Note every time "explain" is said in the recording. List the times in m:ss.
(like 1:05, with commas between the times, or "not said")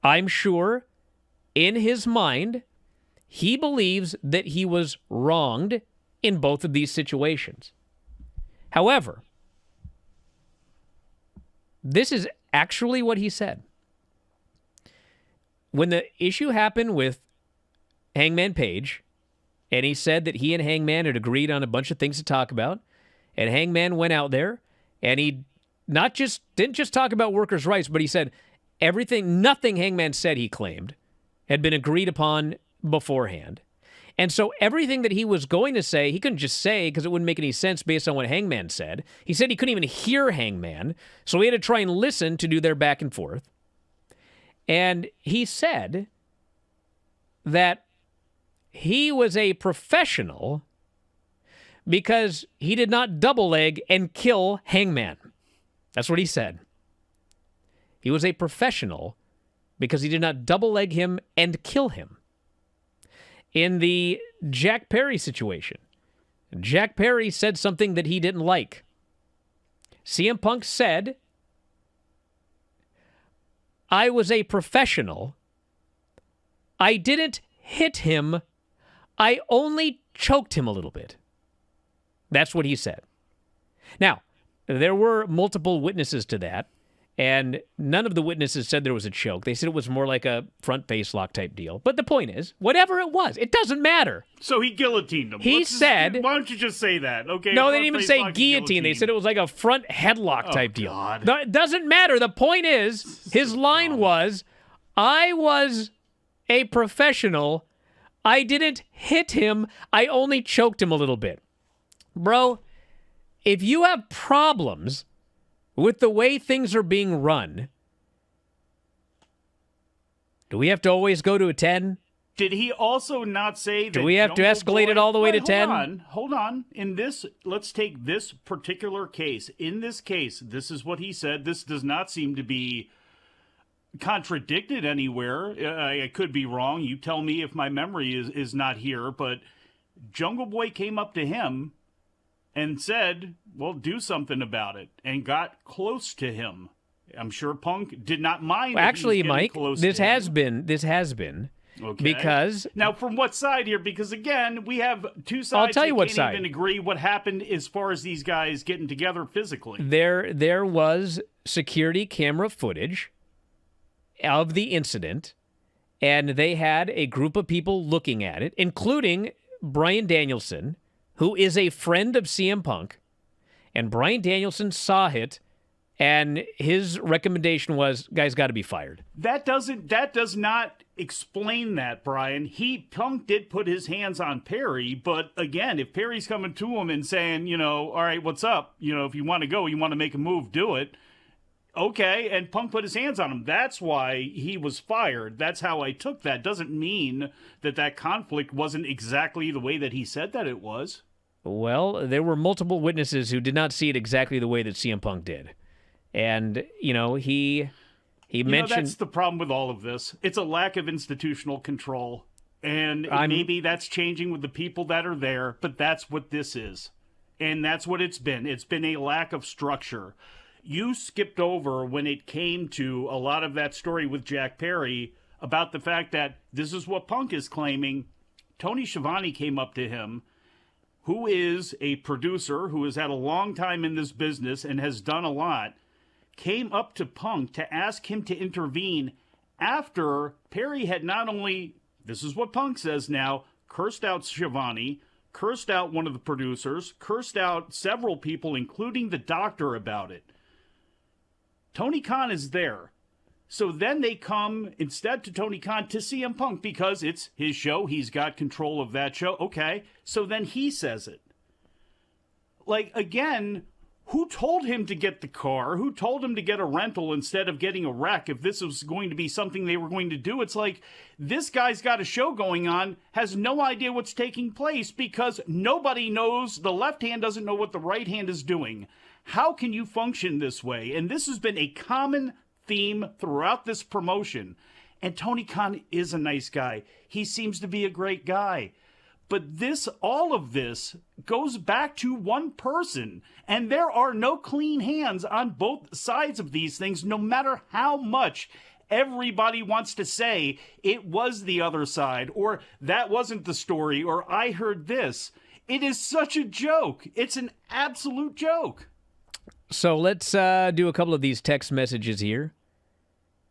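3:00.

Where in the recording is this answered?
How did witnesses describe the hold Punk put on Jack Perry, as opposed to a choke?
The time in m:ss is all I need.
1:30.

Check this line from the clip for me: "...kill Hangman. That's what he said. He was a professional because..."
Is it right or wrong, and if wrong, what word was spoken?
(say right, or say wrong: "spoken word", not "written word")
right.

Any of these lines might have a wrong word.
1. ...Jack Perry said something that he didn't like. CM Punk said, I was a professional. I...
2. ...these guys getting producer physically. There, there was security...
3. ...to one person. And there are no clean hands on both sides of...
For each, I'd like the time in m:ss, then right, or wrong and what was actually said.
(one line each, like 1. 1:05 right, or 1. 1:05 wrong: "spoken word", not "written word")
1. 1:06 right
2. 2:38 wrong: "together", not "producer"
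3. 4:51 right.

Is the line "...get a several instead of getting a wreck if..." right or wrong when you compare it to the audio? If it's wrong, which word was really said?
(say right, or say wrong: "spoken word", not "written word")
wrong: "rental", not "several".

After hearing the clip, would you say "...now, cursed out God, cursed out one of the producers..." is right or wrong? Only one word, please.
wrong.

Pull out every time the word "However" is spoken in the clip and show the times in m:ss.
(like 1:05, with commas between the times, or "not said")
0:08.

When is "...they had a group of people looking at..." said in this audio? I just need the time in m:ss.
2:46.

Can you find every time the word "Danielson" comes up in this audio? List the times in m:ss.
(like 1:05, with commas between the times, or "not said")
2:50, 2:54.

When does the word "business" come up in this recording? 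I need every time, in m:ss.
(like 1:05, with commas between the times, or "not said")
3:54.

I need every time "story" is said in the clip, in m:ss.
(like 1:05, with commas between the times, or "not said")
3:43, 5:03.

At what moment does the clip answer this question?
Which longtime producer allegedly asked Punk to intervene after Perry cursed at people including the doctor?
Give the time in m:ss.
3:48.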